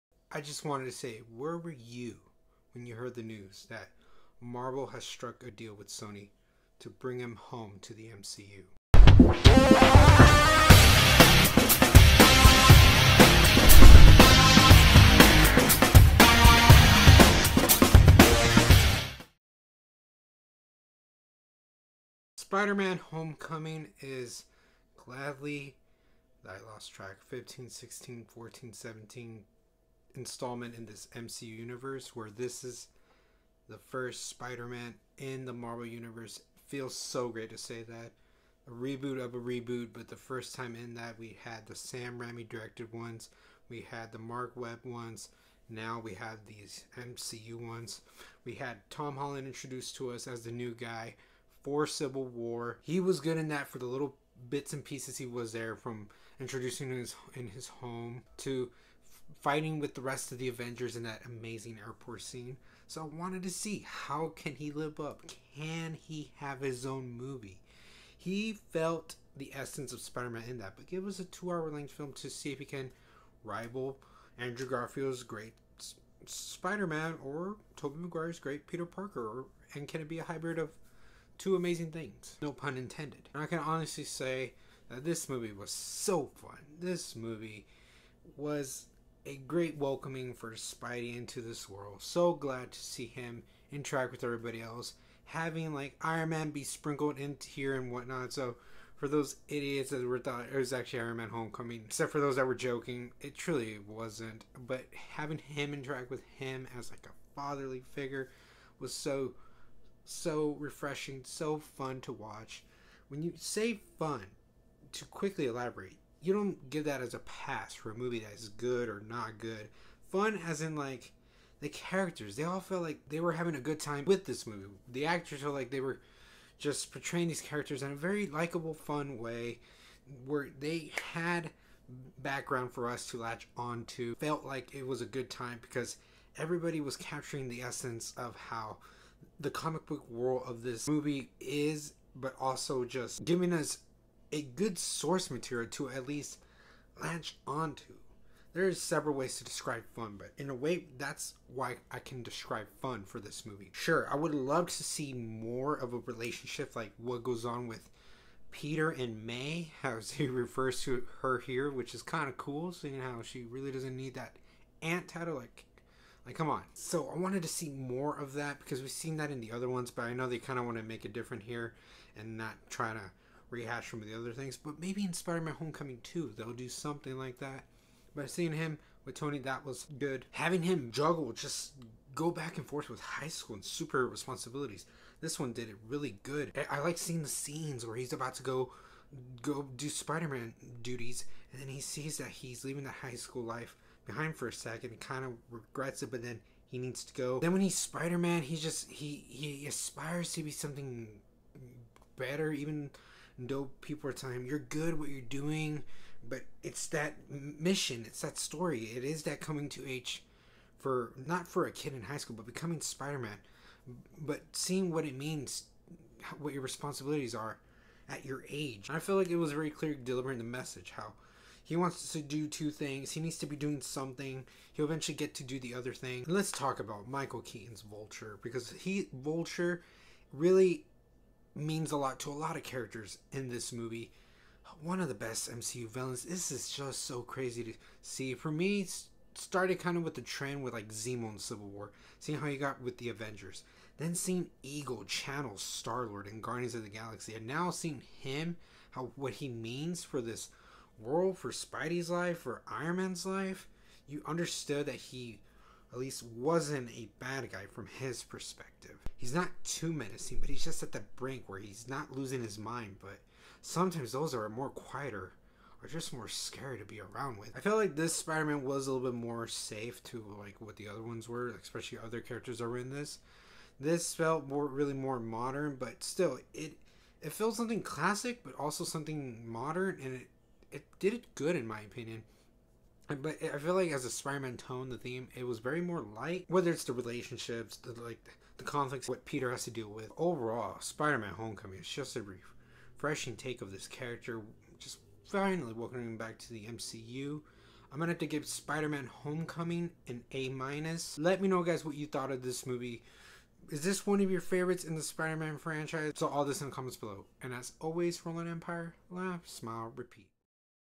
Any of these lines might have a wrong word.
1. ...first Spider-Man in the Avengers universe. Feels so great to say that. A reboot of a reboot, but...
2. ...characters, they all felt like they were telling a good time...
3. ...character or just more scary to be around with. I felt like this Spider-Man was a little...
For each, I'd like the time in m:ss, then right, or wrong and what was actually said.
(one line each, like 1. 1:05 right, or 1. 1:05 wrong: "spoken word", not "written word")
1. 0:33 wrong: "Marvel", not "Avengers"
2. 2:01 wrong: "having", not "telling"
3. 4:24 wrong: "quieter", not "character".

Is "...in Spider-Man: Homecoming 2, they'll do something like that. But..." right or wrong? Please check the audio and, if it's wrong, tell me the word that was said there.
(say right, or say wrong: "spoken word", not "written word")
right.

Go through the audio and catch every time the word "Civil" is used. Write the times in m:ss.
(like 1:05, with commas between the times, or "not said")
0:51, 4:01.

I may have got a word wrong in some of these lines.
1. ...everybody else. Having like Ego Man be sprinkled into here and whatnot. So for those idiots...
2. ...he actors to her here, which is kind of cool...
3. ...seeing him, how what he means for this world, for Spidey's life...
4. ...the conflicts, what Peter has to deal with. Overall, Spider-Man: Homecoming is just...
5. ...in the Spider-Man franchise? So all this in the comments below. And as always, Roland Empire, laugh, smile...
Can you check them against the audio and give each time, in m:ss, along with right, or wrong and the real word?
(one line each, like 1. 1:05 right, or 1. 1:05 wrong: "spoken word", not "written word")
1. 1:34 wrong: "Iron", not "Ego"
2. 2:40 wrong: "refers", not "actors"
3. 4:07 right
4. 4:48 right
5. 5:04 right.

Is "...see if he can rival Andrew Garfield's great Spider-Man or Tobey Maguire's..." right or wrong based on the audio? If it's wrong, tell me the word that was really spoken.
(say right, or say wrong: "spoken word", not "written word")
right.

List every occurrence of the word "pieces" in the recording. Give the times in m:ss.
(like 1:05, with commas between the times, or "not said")
0:54.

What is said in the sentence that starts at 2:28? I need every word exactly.
There is several ways to describe fun, but in a way, that's why I can describe fun for this movie.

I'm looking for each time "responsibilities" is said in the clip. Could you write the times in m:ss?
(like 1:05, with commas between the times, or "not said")
3:04, 3:36.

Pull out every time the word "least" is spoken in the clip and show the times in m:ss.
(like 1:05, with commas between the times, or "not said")
2:26, 4:15.